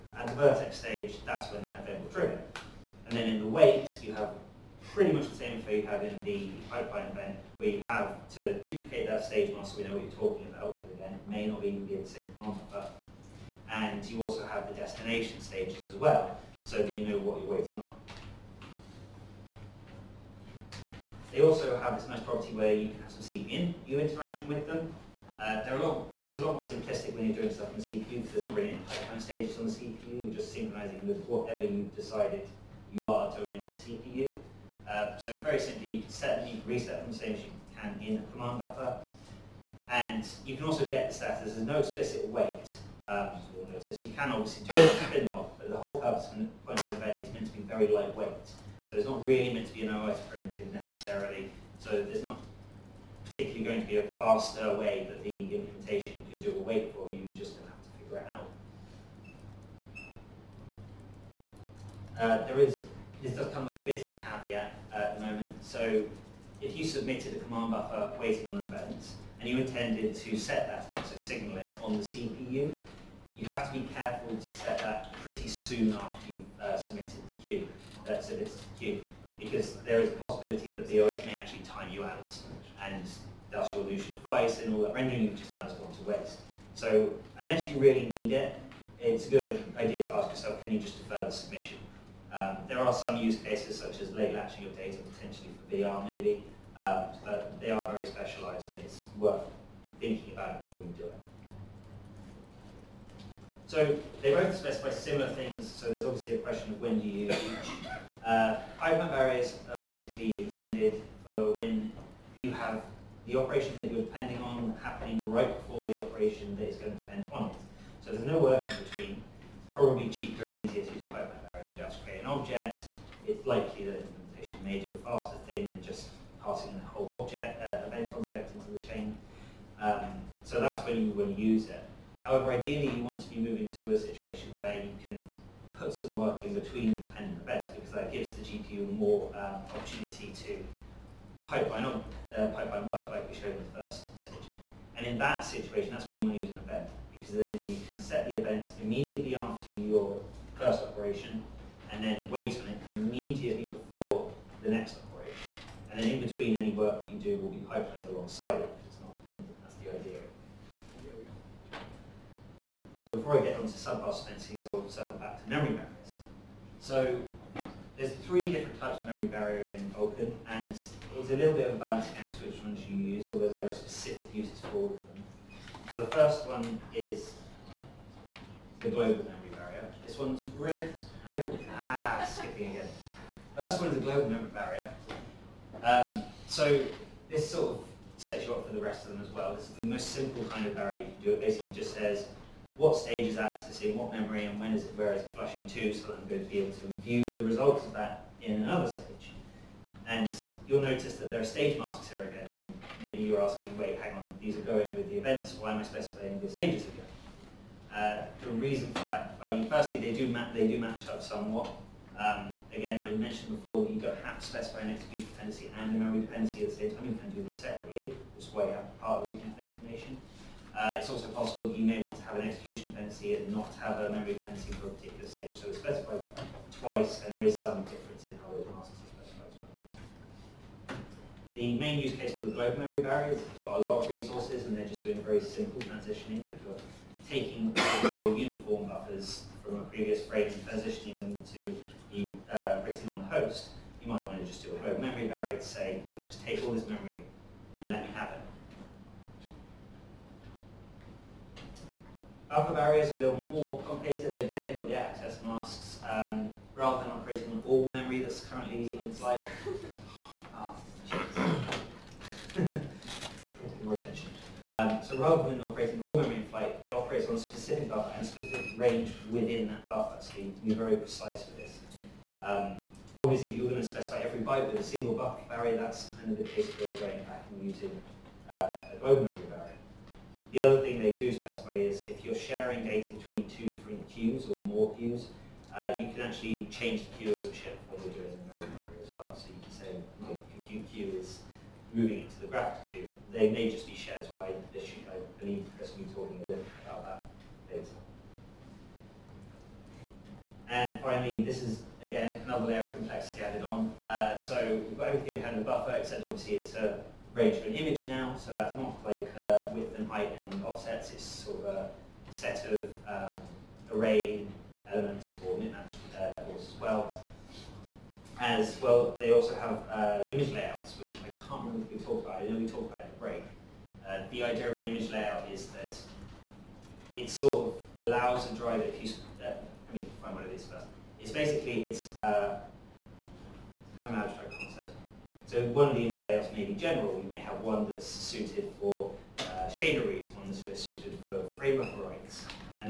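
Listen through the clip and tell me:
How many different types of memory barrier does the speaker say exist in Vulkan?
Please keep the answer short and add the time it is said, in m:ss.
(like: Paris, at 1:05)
3, at 2:48.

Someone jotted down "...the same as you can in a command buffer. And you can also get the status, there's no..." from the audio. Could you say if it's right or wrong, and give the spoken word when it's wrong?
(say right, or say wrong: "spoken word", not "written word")
right.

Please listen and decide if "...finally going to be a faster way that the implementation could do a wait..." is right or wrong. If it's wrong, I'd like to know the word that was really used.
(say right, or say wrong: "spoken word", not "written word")
wrong: "particularly", not "finally".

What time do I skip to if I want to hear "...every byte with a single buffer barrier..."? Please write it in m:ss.
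4:34.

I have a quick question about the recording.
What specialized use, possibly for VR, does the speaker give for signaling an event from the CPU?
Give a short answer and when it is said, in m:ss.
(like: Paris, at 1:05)
late latching of data, at 1:34.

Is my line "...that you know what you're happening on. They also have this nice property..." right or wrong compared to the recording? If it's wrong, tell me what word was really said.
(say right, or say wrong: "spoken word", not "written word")
wrong: "waiting", not "happening".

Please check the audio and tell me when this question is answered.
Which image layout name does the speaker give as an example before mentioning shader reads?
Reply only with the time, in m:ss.
5:36.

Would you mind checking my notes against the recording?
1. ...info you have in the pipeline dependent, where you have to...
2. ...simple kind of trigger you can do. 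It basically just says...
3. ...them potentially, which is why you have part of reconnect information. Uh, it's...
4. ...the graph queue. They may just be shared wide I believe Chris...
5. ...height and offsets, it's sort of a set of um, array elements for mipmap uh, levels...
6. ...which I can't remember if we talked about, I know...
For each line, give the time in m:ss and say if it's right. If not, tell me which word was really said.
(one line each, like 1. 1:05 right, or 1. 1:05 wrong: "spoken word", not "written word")
1. 0:05 wrong: "event", not "dependent"
2. 3:10 wrong: "barrier", not "trigger"
3. 3:37 wrong: "separately", not "potentially"
4. 4:52 right
5. 5:10 right
6. 5:21 right.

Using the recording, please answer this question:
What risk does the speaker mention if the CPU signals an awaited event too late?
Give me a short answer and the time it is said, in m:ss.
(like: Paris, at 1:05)
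lose your device, at 1:23.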